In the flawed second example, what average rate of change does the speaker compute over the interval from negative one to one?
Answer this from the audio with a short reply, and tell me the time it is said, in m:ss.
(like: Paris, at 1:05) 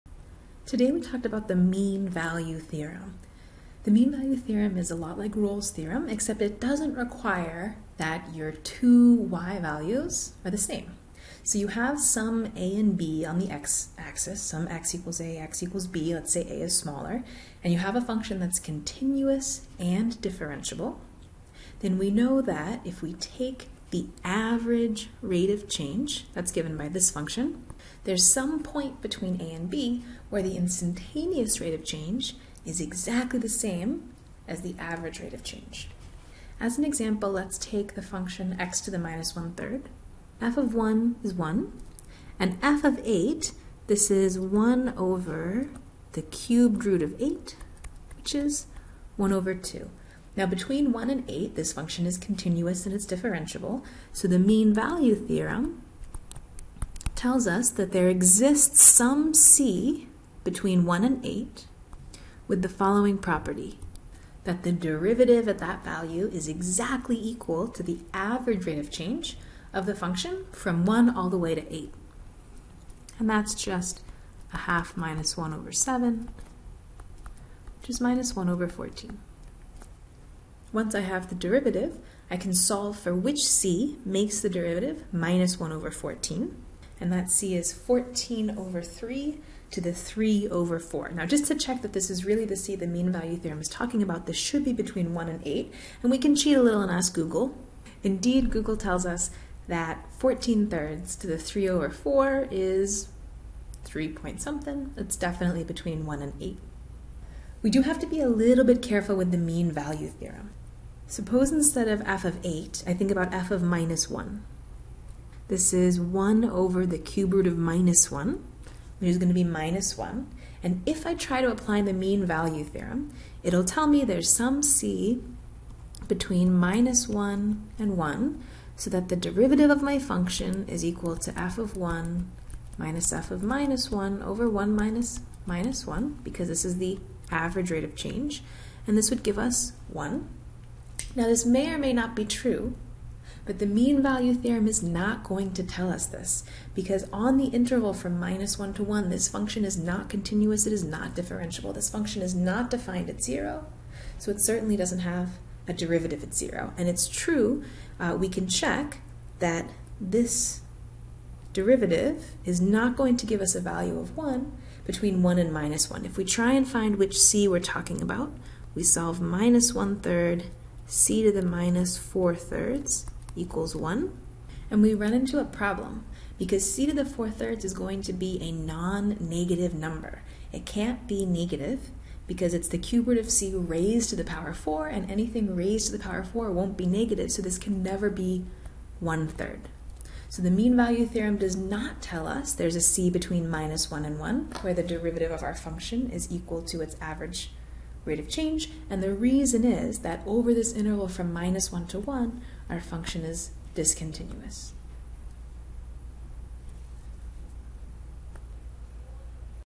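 1, at 2:18.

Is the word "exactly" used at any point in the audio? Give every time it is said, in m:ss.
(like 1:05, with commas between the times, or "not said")
0:32, 1:06.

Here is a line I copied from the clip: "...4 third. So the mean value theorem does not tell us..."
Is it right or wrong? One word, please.
wrong.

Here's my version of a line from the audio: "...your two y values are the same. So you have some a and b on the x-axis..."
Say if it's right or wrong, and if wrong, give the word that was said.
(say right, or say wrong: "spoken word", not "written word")
right.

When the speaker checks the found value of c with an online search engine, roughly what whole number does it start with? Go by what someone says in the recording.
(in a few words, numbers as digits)
3.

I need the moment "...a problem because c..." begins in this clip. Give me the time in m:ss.
2:55.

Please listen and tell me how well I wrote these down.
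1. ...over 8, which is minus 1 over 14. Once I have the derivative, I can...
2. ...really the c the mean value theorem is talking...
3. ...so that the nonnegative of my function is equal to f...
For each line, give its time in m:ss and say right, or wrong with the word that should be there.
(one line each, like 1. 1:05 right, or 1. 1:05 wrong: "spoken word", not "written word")
1. 1:15 wrong: "7", not "8"
2. 1:32 right
3. 2:08 wrong: "derivative", not "nonnegative".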